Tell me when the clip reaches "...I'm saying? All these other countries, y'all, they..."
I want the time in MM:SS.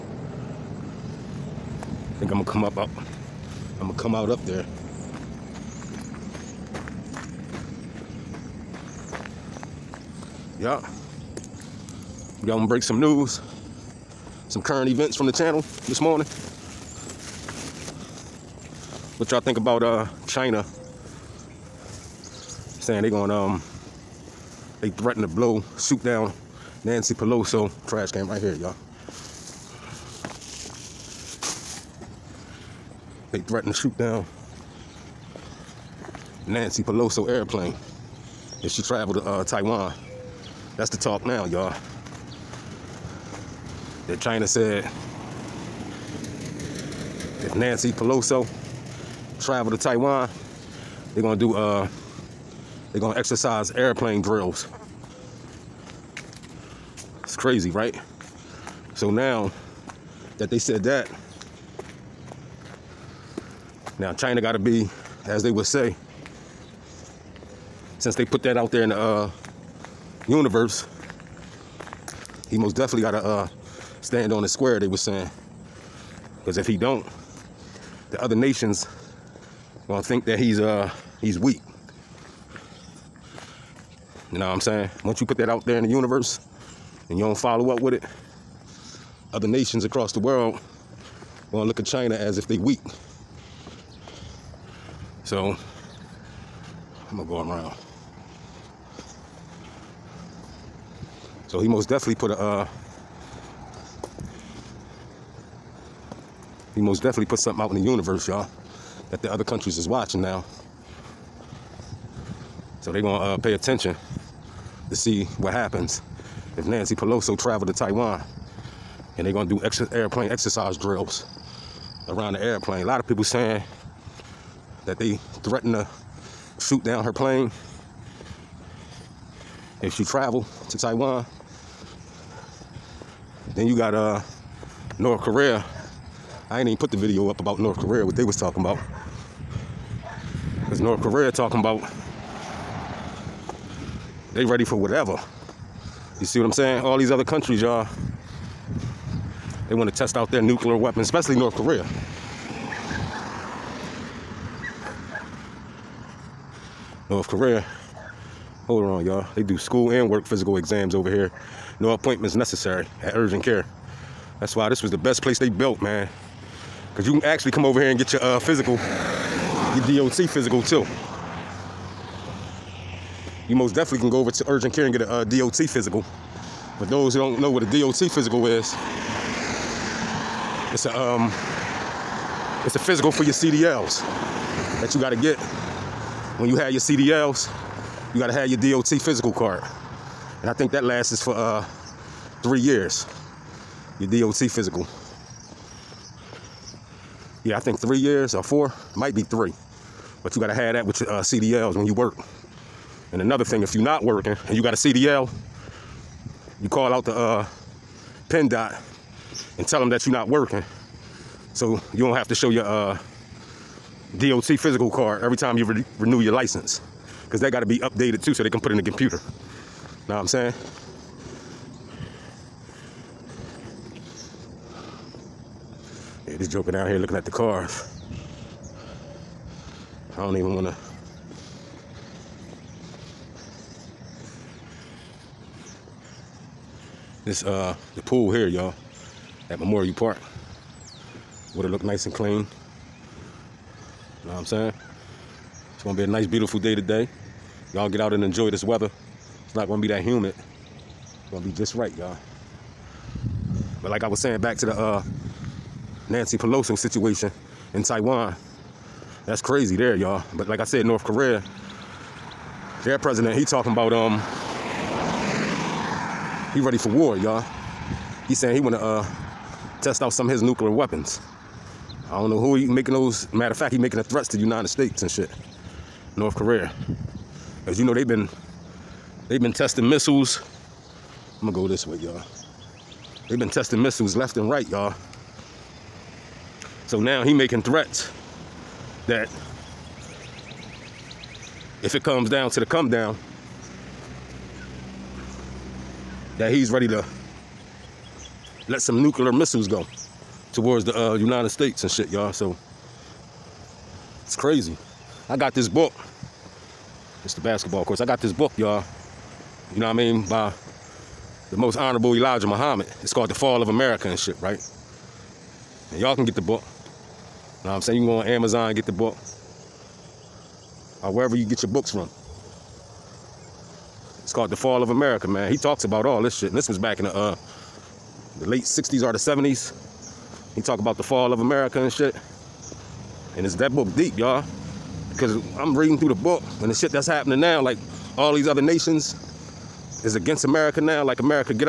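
02:26.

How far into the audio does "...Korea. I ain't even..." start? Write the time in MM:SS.
02:15.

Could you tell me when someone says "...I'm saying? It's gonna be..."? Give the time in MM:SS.
04:04.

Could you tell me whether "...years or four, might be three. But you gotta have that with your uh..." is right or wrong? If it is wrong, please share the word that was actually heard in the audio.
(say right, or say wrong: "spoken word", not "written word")
right.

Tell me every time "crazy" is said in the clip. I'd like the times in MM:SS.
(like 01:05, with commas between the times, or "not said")
00:57, 04:19, 05:04.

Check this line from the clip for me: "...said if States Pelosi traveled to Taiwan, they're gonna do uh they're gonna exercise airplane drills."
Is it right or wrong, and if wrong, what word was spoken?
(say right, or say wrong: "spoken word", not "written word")
wrong: "Nancy", not "States".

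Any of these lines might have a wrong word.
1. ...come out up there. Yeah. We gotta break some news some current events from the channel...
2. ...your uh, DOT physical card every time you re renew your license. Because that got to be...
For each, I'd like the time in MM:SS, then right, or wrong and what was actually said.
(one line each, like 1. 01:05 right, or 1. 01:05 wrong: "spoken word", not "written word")
1. 00:03 right
2. 03:32 right.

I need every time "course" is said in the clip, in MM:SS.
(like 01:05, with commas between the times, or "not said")
05:07.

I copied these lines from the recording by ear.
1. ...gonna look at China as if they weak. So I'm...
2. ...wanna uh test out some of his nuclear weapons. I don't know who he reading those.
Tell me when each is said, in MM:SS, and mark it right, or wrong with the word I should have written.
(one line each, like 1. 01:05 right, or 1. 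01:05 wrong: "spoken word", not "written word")
1. 01:31 right
2. 04:28 wrong: "making", not "reading".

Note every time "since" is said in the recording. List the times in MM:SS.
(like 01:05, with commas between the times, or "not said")
01:07.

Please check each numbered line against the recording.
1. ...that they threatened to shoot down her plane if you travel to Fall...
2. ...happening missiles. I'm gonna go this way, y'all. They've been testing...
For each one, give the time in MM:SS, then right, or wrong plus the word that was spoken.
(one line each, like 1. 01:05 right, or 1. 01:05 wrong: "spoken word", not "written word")
1. 02:04 wrong: "Taiwan", not "Fall"
2. 04:39 wrong: "testing", not "happening".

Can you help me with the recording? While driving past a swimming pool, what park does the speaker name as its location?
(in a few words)
Memorial Park.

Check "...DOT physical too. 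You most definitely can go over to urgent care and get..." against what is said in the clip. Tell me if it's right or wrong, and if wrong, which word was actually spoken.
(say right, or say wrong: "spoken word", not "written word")
right.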